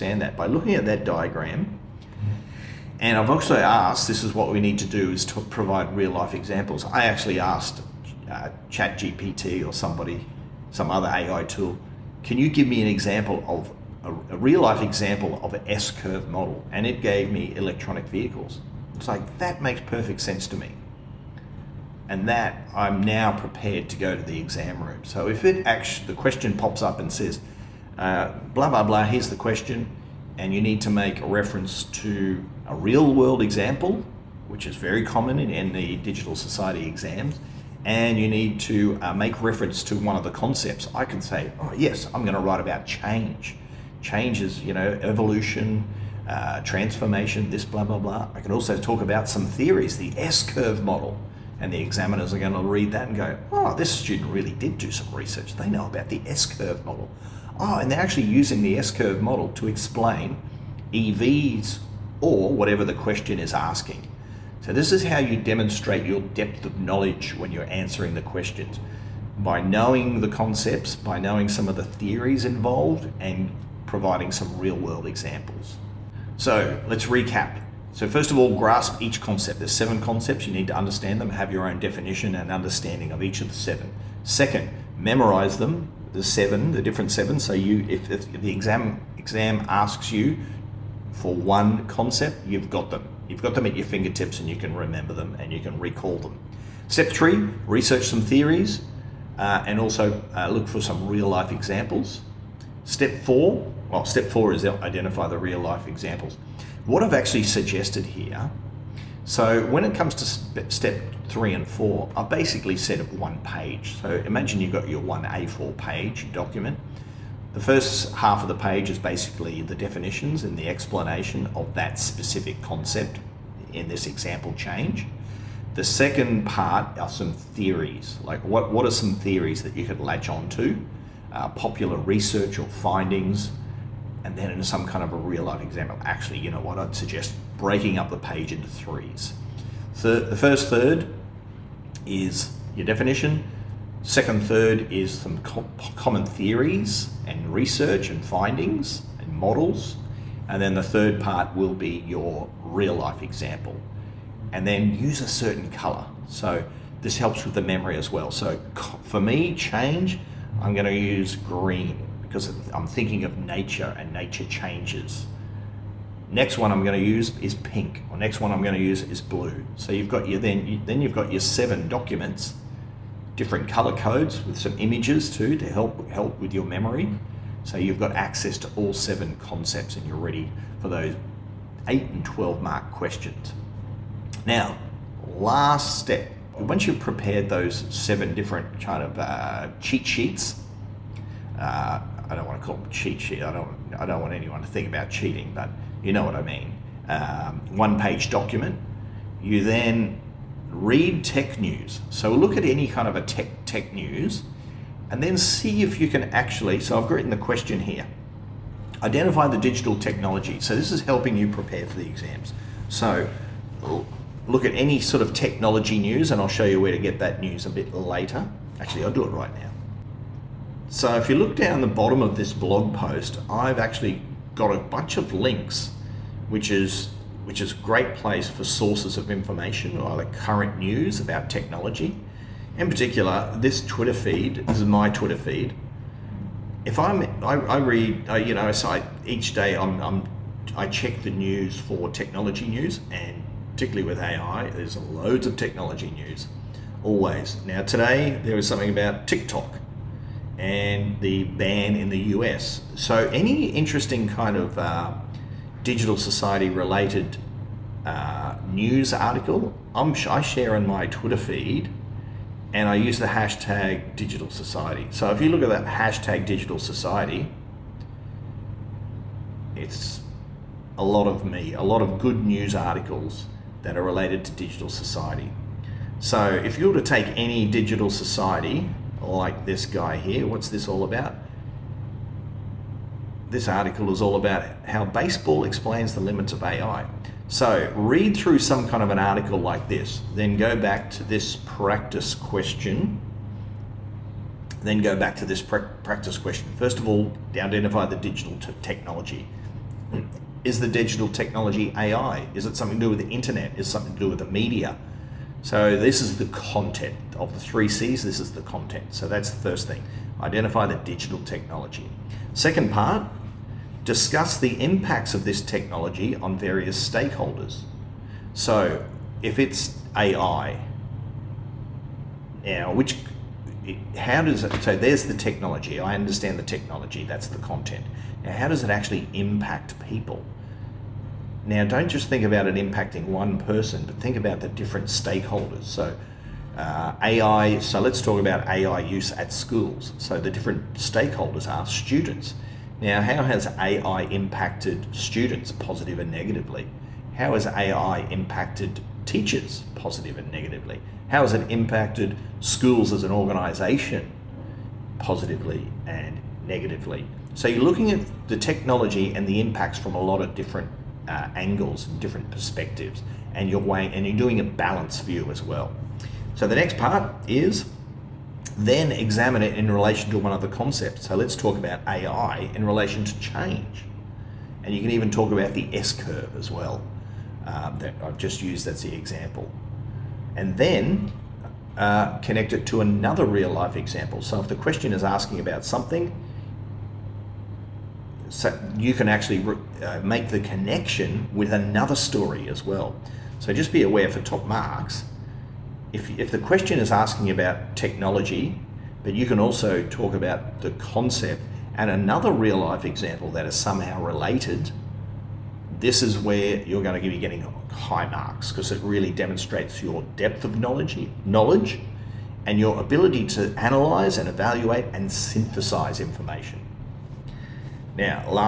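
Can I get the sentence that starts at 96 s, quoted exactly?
Step three, research some theories uh, and also uh, look for some real life examples.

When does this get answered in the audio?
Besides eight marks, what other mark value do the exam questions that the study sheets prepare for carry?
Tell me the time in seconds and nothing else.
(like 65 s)
182 s.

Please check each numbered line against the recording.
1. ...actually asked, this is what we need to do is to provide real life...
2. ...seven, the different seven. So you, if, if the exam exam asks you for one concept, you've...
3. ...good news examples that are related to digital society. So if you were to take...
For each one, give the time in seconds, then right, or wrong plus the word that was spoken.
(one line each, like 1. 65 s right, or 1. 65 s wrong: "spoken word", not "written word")
1. 3 s right
2. 86 s right
3. 272 s wrong: "articles", not "examples".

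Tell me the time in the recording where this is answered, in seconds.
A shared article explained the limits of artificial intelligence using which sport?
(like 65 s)
285 s.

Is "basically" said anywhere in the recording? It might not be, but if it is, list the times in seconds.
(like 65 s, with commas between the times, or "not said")
112 s, 118 s.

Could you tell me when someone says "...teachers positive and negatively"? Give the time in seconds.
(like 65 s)
349 s.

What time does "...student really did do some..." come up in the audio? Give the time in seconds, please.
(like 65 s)
53 s.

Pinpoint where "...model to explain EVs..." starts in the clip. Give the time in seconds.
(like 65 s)
59 s.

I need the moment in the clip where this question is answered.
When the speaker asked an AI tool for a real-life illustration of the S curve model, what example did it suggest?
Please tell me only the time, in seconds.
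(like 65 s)
17 s.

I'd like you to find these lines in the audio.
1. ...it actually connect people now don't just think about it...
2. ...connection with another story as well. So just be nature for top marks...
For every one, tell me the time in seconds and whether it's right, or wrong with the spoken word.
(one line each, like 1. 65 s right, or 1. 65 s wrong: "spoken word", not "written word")
1. 328 s wrong: "impact", not "connect"
2. 390 s wrong: "aware", not "nature".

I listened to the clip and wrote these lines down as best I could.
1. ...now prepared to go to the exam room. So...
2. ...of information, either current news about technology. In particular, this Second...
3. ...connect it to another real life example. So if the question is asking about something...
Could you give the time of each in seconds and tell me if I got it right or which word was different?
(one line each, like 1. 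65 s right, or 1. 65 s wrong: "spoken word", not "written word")
1. 23 s right
2. 229 s wrong: "Twitter", not "Second"
3. 382 s right.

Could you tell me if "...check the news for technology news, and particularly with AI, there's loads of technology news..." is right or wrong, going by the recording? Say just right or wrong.
right.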